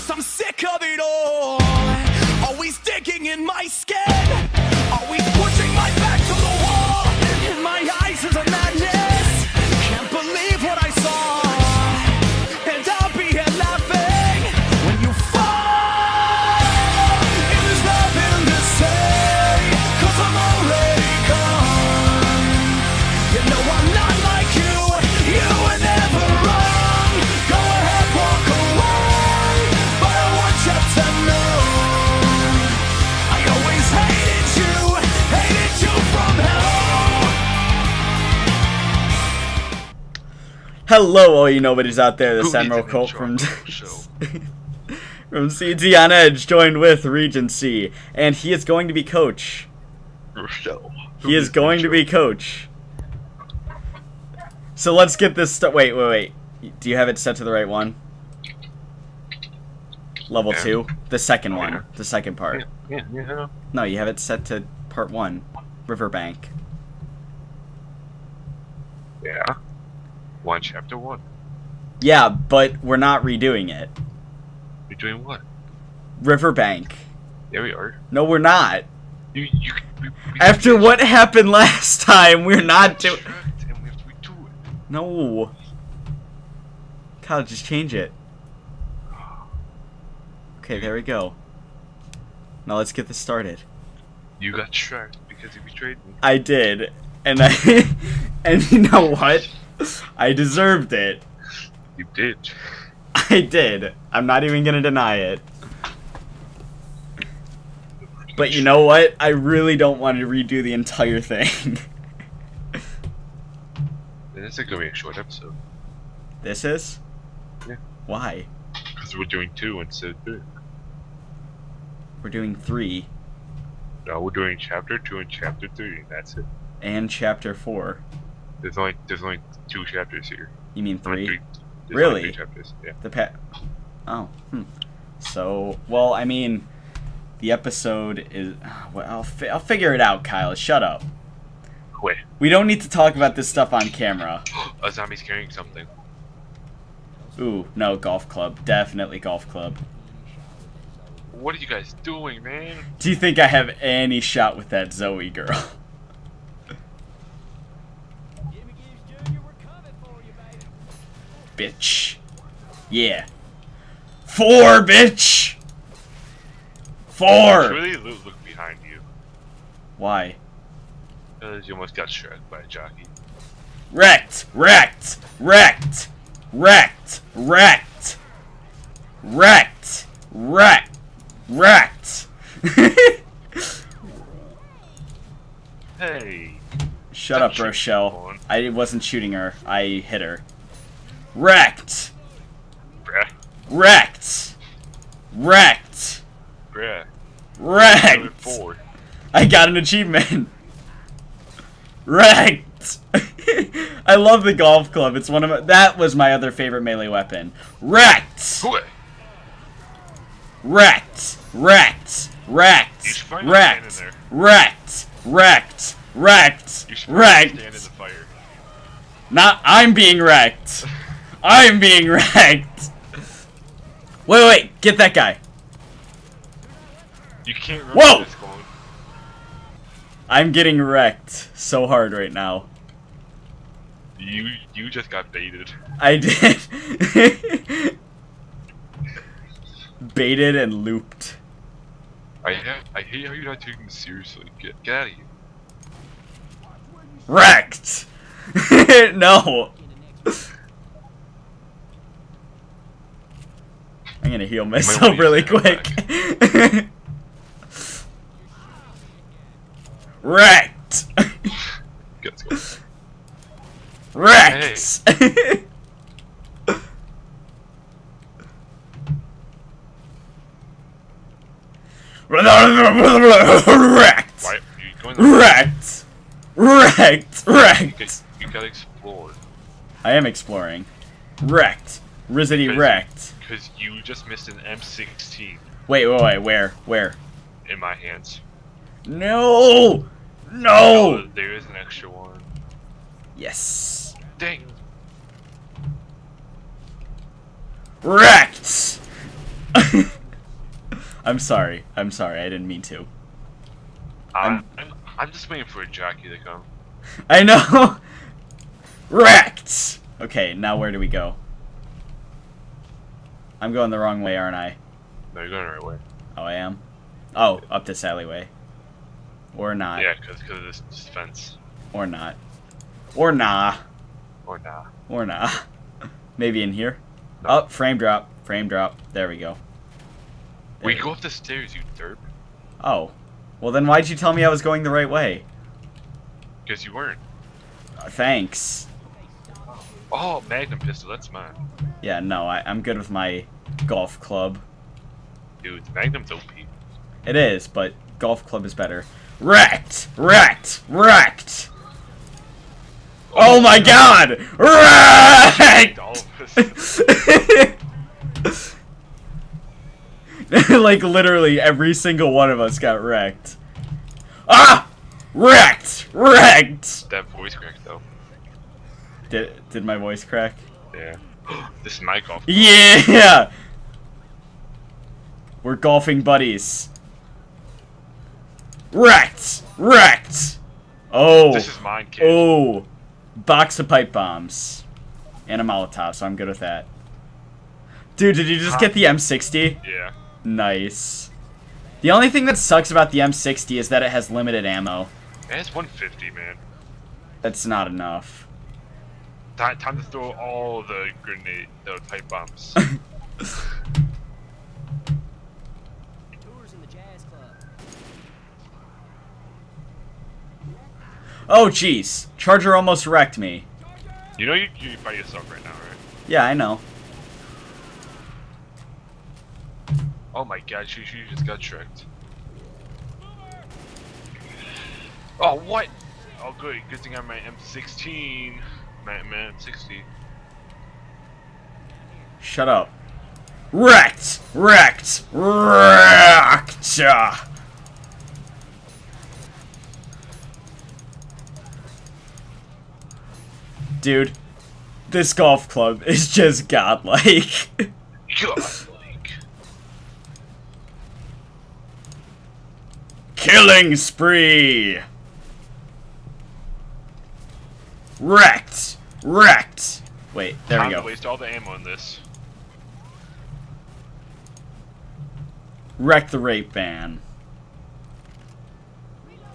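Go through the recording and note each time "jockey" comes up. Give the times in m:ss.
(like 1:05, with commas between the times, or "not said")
2:52, 5:05.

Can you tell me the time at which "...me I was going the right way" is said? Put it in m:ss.
5:34.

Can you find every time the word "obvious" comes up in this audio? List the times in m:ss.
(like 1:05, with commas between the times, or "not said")
not said.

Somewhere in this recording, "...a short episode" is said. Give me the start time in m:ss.
1:54.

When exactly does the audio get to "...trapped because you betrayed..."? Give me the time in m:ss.
1:34.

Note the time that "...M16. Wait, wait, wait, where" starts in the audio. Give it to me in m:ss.
4:44.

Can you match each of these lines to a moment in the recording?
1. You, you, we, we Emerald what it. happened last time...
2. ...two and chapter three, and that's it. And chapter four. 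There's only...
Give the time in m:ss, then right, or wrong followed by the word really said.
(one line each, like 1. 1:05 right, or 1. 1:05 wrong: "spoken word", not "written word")
1. 1:19 wrong: "After", not "Emerald"
2. 2:04 right.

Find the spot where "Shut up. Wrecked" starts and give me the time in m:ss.
7:12.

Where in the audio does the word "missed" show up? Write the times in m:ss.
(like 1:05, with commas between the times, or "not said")
4:44.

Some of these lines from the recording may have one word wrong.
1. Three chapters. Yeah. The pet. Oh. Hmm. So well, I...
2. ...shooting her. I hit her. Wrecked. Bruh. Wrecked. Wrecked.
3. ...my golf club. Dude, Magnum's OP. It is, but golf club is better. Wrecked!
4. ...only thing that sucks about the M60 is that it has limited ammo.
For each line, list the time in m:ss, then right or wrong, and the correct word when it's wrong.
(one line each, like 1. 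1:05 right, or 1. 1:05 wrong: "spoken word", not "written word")
1. 2:12 right
2. 3:09 right
3. 5:43 right
4. 6:32 right.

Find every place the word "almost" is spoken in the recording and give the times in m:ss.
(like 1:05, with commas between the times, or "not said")
2:51, 6:52.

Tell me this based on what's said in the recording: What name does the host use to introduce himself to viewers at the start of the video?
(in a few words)
Emerald Colt.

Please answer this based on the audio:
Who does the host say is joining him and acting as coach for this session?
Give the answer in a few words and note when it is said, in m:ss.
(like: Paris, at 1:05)
Regency, at 0:47.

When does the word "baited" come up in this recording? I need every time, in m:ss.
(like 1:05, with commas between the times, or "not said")
3:55, 4:00.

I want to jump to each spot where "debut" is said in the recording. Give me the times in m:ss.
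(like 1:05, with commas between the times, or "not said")
not said.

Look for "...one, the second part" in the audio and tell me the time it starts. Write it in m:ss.
1:01.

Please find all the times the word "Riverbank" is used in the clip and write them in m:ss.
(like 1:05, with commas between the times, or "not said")
1:05, 1:16.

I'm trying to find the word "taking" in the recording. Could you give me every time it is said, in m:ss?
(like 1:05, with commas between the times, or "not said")
4:03.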